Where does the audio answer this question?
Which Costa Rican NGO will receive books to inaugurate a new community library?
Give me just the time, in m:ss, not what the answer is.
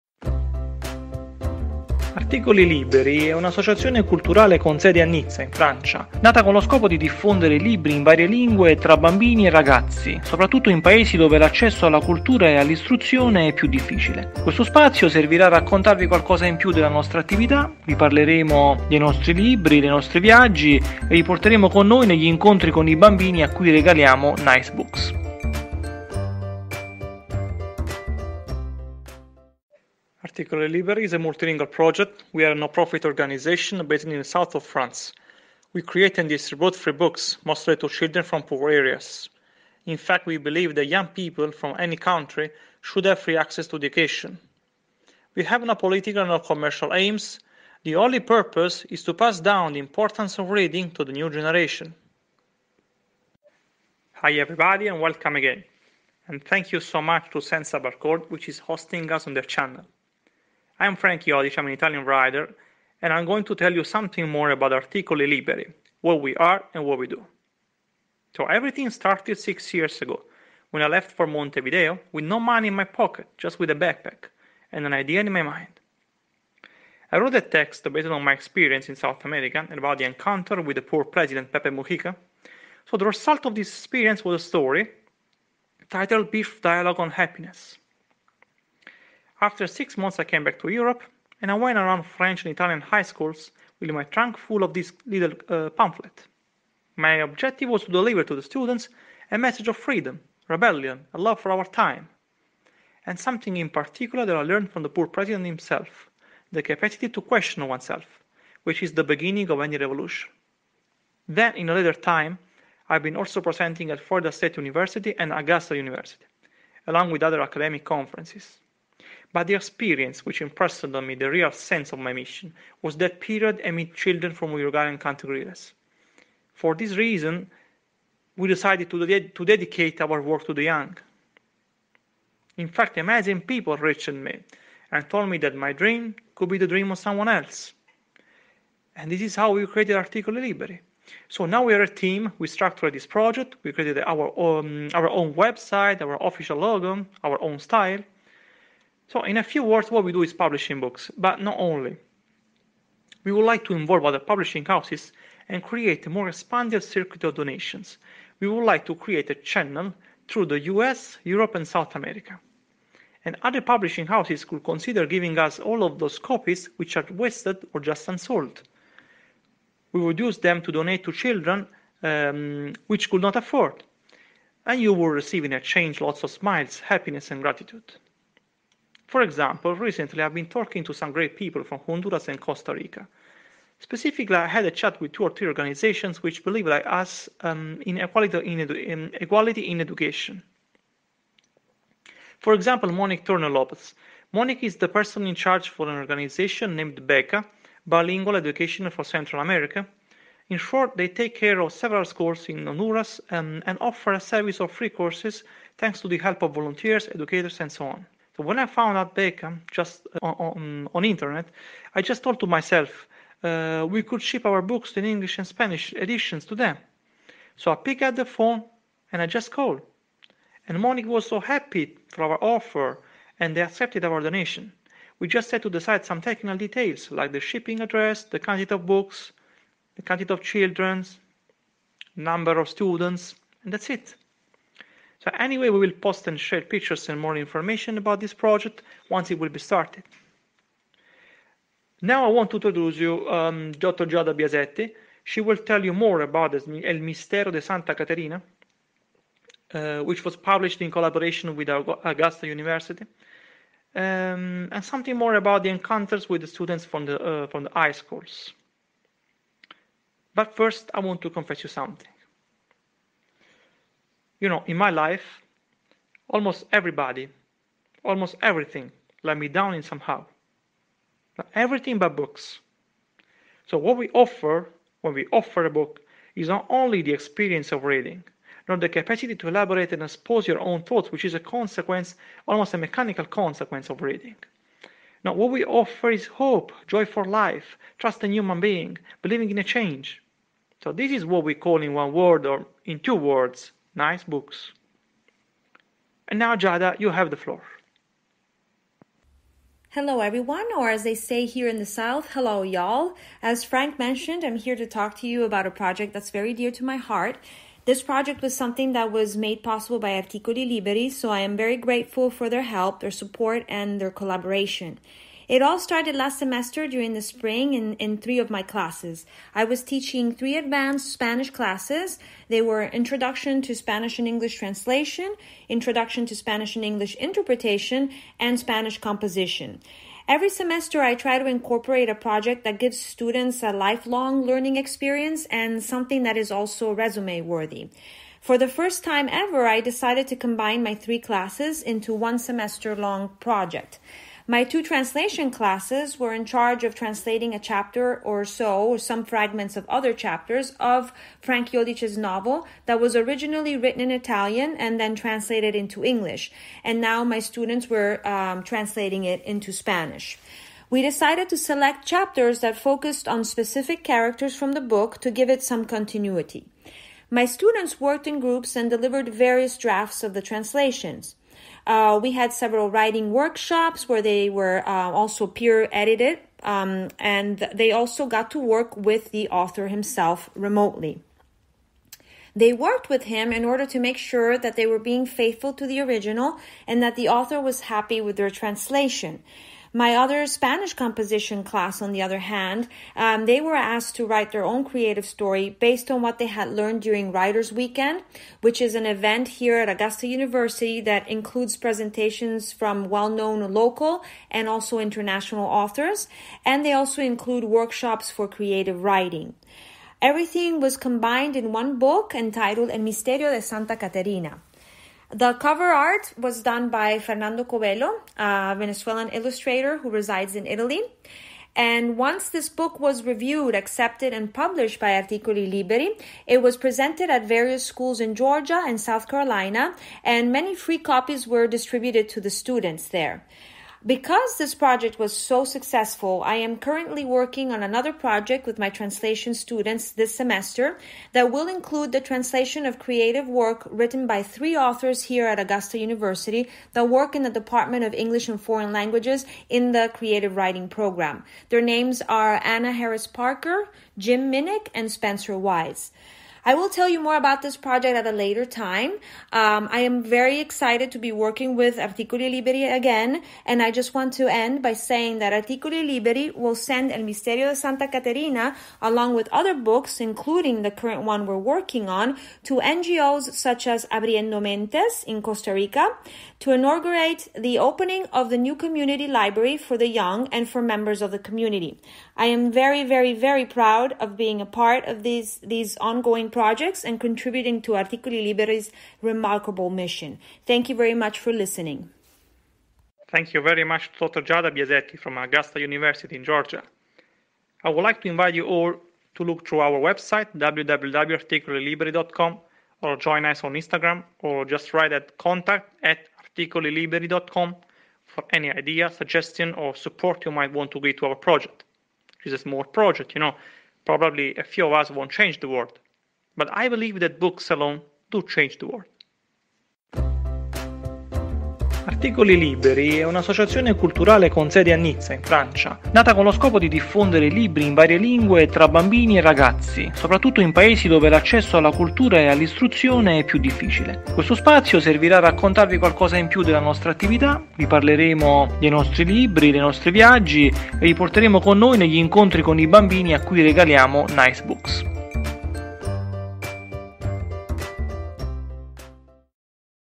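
7:54.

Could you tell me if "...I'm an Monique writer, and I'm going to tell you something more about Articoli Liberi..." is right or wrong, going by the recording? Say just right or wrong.
wrong.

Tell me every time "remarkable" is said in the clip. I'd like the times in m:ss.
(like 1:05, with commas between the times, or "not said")
8:09.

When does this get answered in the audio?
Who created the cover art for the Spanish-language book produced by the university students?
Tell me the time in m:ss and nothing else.
6:57.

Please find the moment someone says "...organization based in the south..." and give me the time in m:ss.
0:33.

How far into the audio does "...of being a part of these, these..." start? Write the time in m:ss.
8:04.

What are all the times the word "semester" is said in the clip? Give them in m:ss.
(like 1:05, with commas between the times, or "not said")
5:16, 5:30, 5:42, 7:20.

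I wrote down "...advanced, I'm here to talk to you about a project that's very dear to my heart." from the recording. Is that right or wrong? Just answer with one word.
wrong.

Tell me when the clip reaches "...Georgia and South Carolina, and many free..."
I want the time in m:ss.
7:08.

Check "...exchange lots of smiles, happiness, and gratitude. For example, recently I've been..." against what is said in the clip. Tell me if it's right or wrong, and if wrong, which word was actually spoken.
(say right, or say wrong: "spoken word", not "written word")
right.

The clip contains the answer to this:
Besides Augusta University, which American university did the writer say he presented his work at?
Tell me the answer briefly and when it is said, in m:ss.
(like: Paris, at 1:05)
Florida State University, at 1:54.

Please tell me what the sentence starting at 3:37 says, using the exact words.
So I picked up the phone and I just called.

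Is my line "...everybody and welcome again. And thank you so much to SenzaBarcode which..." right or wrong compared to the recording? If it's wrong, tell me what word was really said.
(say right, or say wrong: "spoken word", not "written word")
right.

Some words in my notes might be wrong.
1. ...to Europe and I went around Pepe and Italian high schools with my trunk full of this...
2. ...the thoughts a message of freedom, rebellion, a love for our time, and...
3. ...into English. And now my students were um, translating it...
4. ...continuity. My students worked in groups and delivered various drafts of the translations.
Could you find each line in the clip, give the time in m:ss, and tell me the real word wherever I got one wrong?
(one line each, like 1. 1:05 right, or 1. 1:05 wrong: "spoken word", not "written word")
1. 1:30 wrong: "French", not "Pepe"
2. 1:38 wrong: "students", not "thoughts"
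3. 5:55 right
4. 6:05 right.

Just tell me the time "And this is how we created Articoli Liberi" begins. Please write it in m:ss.
2:18.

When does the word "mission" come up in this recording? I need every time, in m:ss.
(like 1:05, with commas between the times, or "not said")
2:02, 8:09.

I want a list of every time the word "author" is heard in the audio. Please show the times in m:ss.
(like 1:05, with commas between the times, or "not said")
6:19, 6:27, 6:45, 7:24.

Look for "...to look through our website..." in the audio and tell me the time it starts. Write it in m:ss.
8:19.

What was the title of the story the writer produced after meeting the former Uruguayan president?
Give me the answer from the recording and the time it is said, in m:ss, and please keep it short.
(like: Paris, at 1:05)
Brief Dialogue on Happiness, at 1:26.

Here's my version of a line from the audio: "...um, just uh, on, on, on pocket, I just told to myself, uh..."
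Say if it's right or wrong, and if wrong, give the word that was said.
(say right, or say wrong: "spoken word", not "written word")
wrong: "internet", not "pocket".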